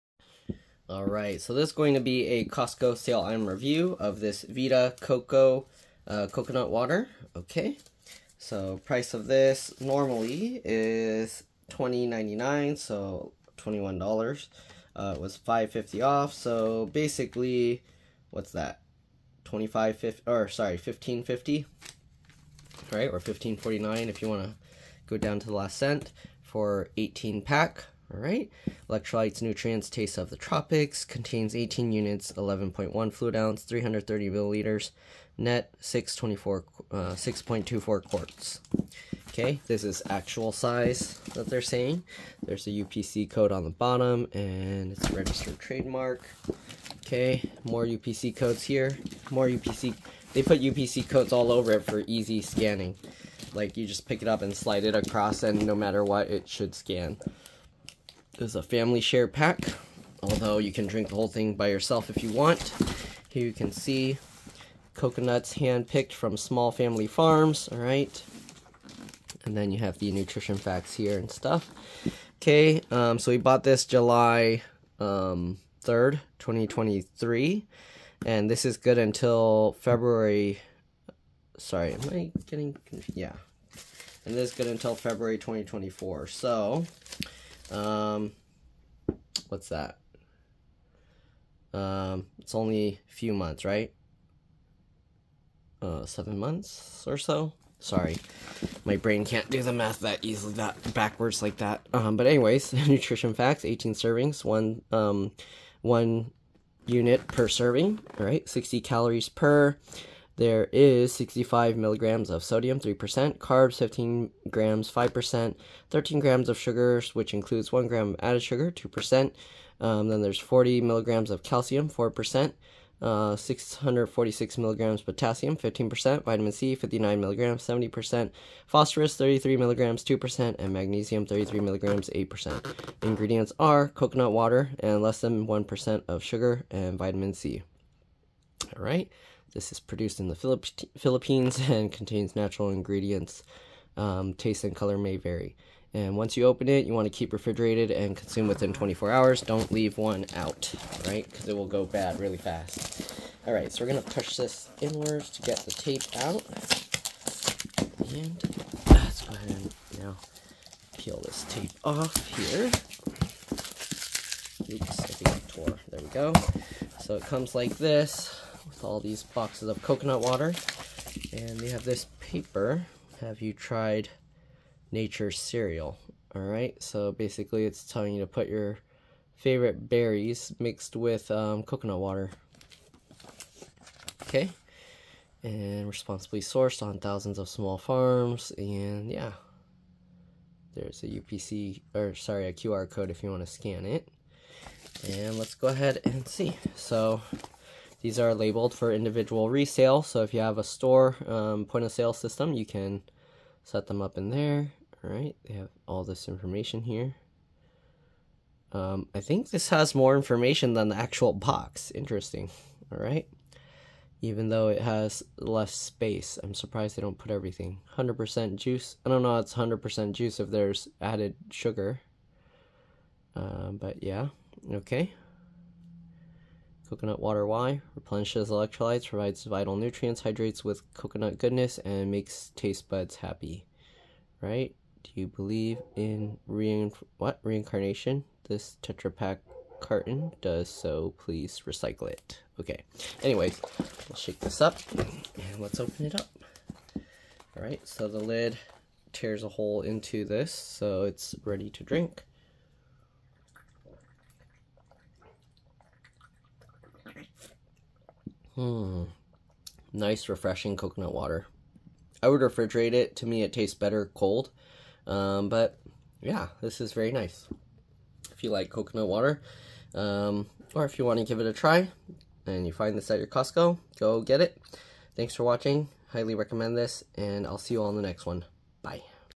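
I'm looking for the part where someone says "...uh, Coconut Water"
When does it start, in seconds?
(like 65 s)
6 s.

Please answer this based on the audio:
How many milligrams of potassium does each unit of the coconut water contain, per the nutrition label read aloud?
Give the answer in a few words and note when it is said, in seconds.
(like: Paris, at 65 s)
646 milligrams, at 123 s.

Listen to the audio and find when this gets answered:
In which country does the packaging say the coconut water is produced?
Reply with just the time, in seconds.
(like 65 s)
140 s.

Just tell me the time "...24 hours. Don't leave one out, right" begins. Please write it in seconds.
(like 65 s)
148 s.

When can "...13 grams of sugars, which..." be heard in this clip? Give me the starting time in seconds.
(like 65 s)
115 s.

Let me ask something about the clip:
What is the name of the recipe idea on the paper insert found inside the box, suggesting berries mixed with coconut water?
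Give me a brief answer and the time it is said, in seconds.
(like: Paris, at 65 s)
Nature Cereal, at 174 s.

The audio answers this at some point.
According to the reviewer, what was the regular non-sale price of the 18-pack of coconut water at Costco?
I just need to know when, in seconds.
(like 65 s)
11 s.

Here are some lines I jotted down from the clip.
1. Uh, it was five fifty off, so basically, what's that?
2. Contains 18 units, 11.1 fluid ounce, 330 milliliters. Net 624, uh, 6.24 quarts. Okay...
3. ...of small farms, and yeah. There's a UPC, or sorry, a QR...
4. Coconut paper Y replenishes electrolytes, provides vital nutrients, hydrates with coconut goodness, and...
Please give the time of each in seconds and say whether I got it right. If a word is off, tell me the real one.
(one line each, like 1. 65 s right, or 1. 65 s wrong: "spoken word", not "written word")
1. 14 s right
2. 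31 s right
3. 187 s right
4. 226 s wrong: "water", not "paper".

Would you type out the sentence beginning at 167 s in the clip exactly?
So it comes like this all these boxes of coconut water.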